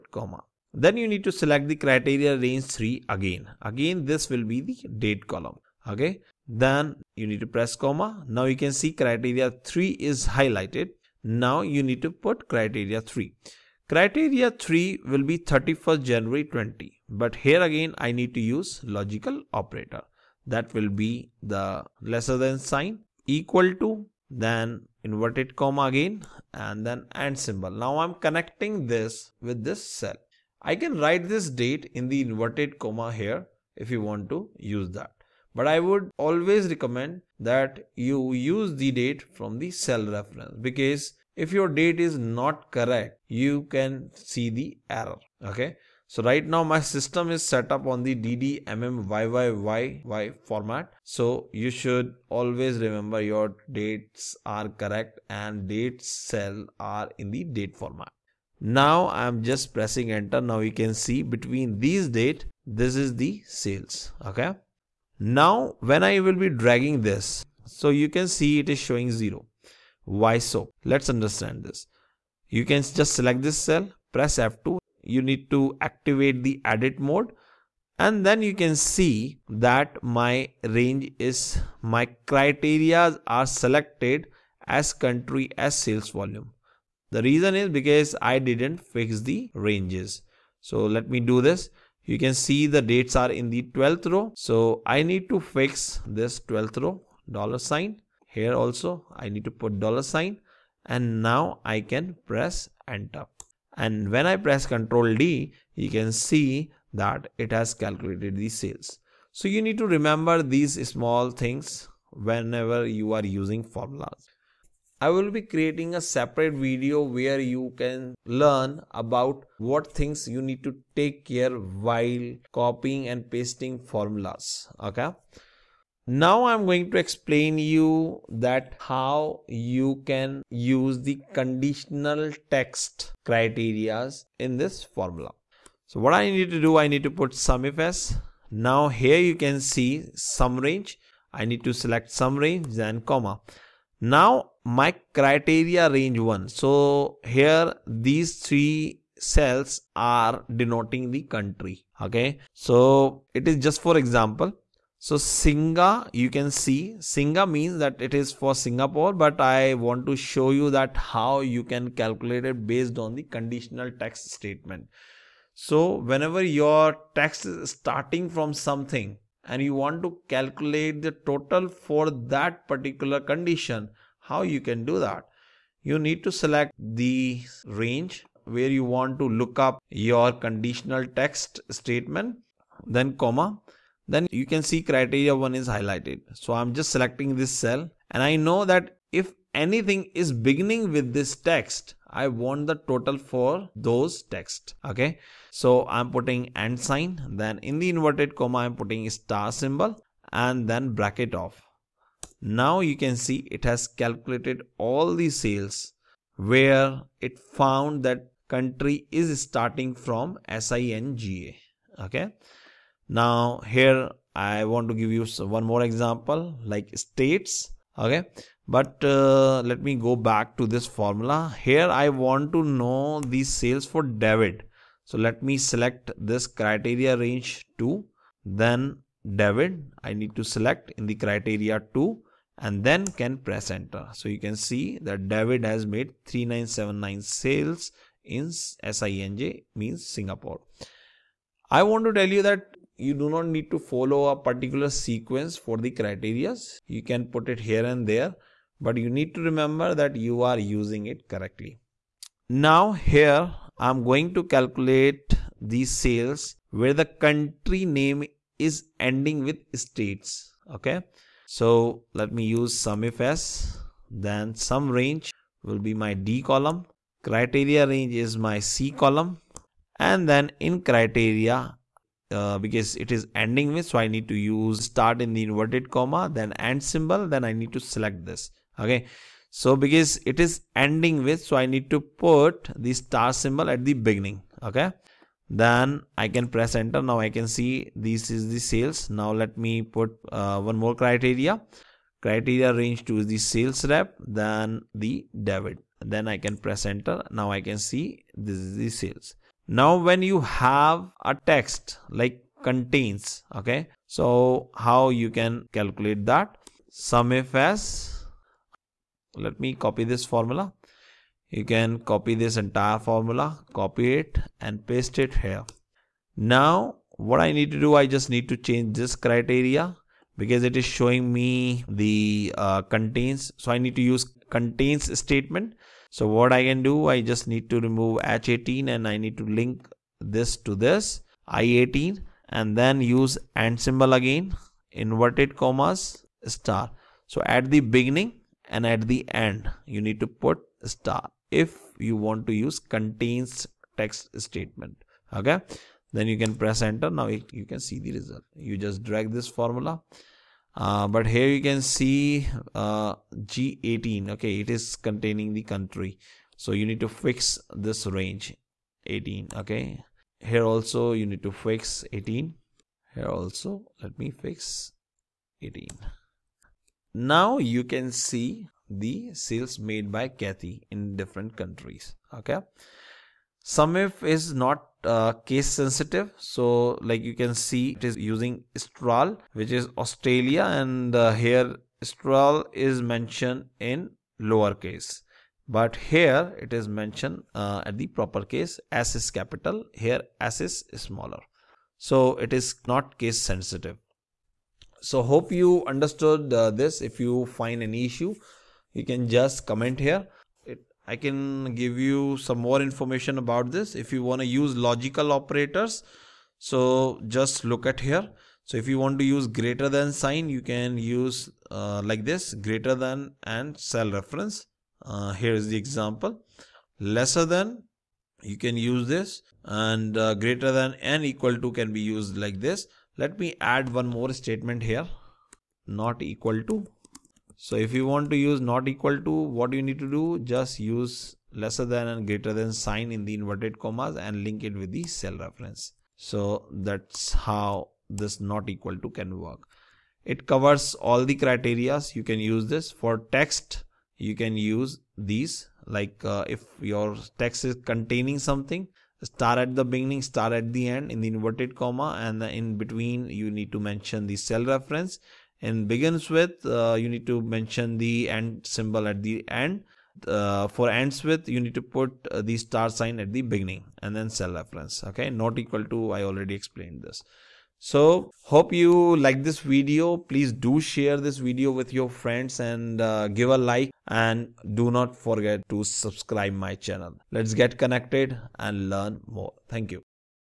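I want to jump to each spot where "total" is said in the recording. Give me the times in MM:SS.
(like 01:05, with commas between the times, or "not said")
02:51, 03:12.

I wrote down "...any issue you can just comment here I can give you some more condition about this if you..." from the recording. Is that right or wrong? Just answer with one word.
wrong.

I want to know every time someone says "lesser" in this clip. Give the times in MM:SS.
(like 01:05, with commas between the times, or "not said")
00:22, 06:56, 07:11.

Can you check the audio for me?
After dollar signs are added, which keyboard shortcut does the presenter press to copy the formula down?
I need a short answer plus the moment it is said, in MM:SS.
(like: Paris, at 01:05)
Control D, at 01:44.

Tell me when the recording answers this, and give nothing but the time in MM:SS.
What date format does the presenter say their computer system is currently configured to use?
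00:48.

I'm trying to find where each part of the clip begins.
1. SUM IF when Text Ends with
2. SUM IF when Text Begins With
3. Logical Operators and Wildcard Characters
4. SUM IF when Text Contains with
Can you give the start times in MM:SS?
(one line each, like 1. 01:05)
1. 04:08
2. 02:06
3. 07:07
4. 05:17.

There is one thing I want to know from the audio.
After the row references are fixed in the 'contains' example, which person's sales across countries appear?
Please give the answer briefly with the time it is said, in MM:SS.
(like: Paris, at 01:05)
Kathy, at 06:10.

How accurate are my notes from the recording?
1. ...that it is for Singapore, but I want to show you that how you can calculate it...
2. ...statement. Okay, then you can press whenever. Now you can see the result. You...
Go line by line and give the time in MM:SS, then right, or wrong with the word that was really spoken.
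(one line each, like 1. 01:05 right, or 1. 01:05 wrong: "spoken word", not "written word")
1. 02:37 right
2. 05:44 wrong: "enter", not "whenever".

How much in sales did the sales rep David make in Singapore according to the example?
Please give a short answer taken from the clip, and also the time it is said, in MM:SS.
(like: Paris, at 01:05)
3979, at 03:56.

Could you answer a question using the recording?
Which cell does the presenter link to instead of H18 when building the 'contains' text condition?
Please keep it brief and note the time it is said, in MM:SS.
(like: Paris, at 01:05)
I18, at 05:31.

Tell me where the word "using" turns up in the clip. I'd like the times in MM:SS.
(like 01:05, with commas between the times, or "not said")
01:53, 04:10, 06:18.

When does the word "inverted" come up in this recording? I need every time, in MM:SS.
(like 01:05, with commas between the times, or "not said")
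00:25, 00:32, 03:17, 04:35, 05:34, 07:13, 07:31.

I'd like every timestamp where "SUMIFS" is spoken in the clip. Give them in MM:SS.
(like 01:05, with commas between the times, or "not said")
02:17, 04:22, 05:06, 06:13.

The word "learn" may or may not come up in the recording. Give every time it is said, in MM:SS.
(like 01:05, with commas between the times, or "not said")
01:58, 07:58.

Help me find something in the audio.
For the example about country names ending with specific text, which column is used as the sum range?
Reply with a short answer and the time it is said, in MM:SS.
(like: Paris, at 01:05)
D column, at 04:26.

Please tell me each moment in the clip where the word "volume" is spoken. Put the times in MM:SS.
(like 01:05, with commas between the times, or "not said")
01:26.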